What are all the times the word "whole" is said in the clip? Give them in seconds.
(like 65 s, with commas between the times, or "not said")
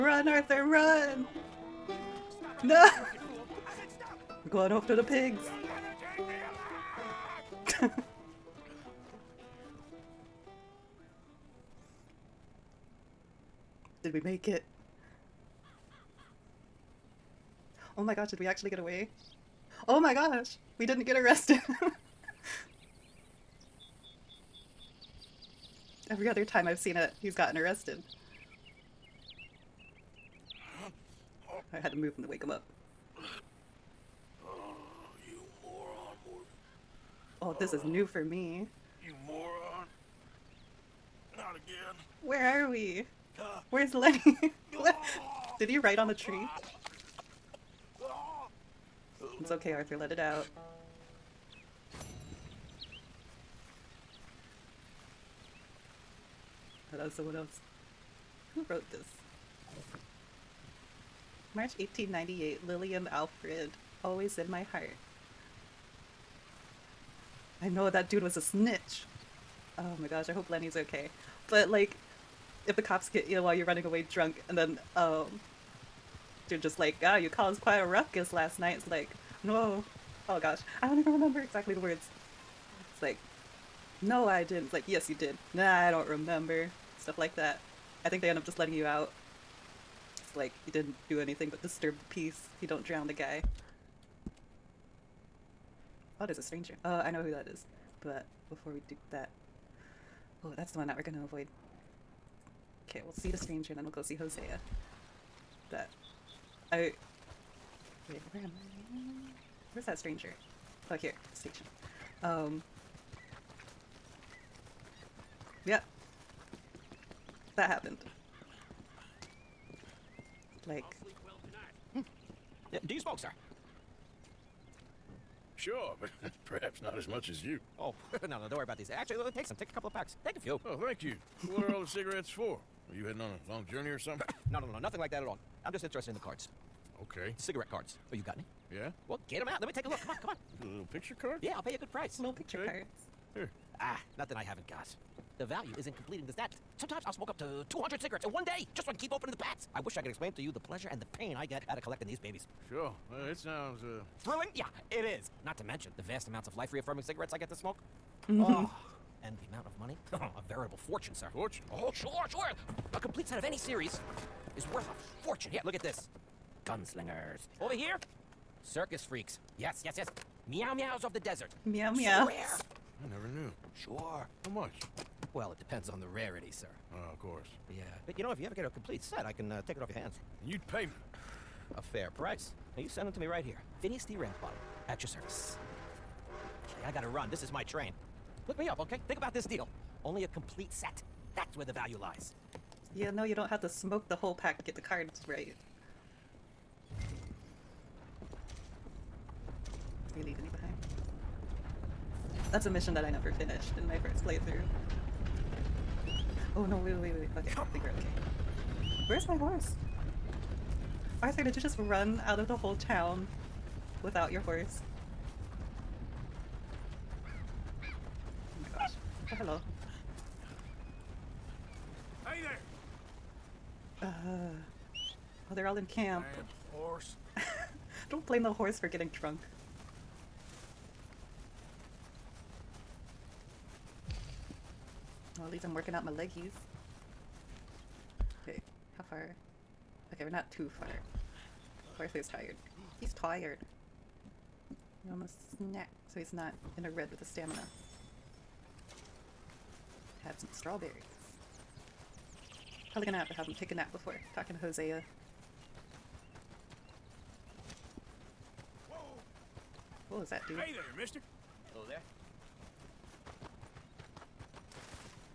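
194 s, 212 s.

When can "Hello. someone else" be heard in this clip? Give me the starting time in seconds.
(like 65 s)
56 s.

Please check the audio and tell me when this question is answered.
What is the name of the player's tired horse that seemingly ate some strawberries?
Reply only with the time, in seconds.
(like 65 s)
241 s.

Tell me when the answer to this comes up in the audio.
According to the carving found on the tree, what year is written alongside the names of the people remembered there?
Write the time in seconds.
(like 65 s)
61 s.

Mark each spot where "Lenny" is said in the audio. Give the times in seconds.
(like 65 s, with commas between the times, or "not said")
43 s, 70 s.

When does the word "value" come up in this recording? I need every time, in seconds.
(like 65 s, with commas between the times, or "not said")
145 s, 191 s.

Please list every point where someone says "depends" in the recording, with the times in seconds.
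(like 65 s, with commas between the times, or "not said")
175 s.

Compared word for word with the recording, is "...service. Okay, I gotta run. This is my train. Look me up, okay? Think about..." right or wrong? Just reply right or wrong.
right.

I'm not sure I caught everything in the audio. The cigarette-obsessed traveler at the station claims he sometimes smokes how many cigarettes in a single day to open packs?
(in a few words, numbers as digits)
200.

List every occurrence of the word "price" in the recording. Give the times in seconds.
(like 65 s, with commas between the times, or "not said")
141 s, 182 s.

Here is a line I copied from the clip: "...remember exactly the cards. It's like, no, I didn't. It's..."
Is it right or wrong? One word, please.
wrong.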